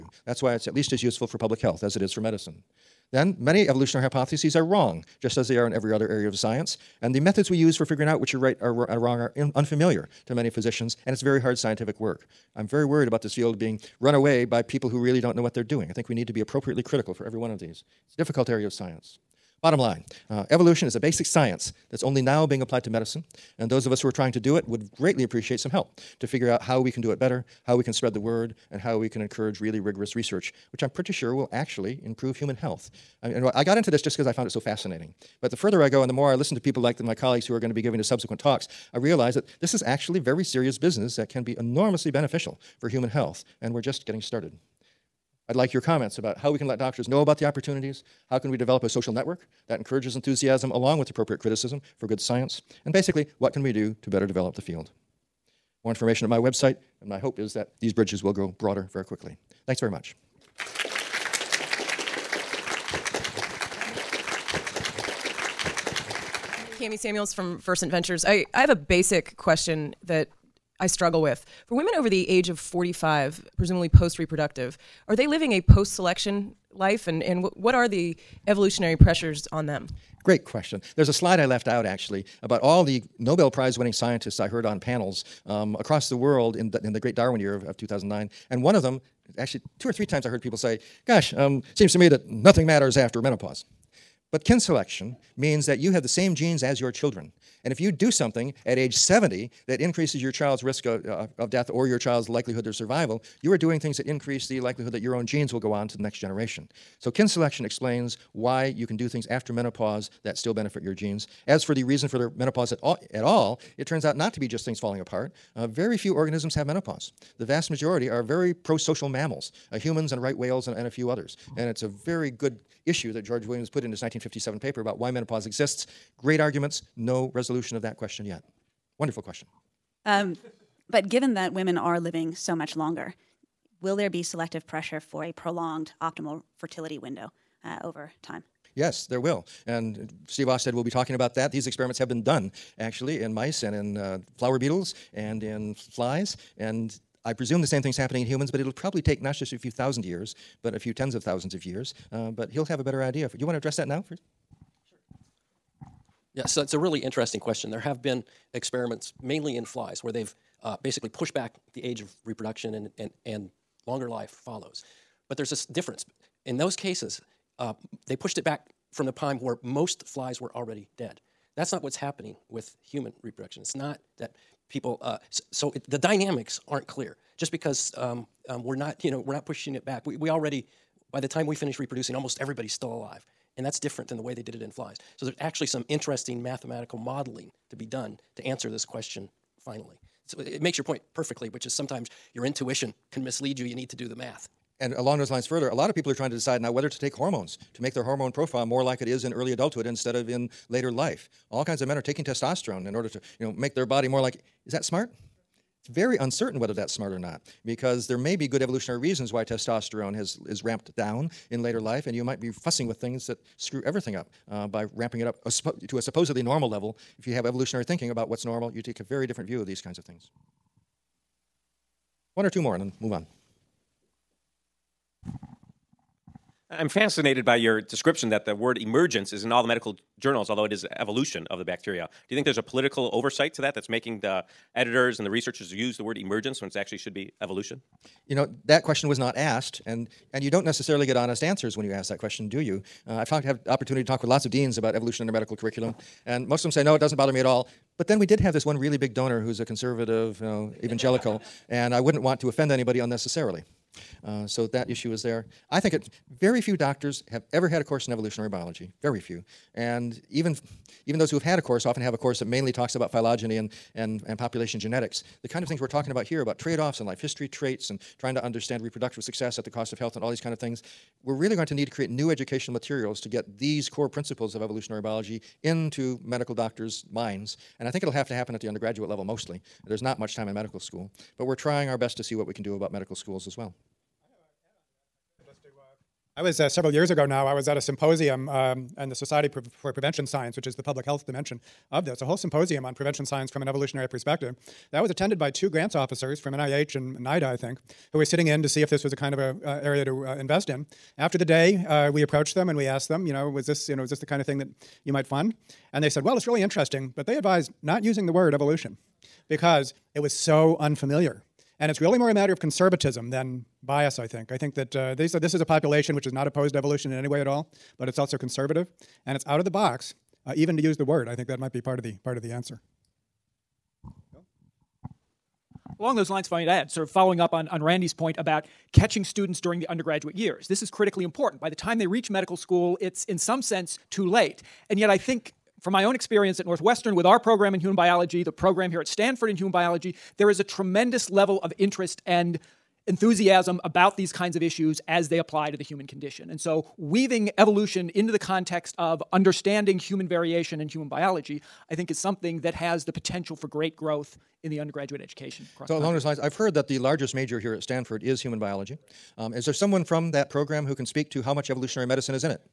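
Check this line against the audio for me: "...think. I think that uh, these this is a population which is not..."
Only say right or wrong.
right.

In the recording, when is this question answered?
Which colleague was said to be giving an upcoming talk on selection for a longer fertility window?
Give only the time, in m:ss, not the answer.
2:20.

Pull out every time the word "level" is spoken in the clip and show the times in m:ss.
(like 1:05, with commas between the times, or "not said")
3:36, 4:39, 5:41.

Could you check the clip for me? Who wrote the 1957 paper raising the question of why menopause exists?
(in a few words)
George Williams.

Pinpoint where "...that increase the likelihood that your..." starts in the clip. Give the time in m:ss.
1:43.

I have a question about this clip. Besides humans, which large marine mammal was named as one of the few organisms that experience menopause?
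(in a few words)
right whales.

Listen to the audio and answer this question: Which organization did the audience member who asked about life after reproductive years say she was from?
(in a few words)
First Ventures.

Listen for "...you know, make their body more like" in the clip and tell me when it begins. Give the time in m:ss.
3:23.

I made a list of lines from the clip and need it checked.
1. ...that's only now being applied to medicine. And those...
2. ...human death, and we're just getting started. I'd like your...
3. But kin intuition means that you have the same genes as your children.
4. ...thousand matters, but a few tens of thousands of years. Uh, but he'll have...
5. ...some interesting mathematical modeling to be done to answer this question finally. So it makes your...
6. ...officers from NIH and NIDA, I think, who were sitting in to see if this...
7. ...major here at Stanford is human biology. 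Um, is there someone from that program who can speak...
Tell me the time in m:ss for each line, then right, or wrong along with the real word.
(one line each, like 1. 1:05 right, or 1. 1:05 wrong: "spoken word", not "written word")
1. 0:21 right
2. 0:42 wrong: "health", not "death"
3. 1:34 wrong: "selection", not "intuition"
4. 2:29 wrong: "years", not "matters"
5. 3:05 right
6. 4:55 right
7. 5:57 right.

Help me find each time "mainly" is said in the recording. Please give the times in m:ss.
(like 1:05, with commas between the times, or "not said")
2:39, 4:22.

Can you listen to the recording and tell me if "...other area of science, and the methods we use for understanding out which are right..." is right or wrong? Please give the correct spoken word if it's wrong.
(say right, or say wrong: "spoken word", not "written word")
wrong: "figuring", not "understanding".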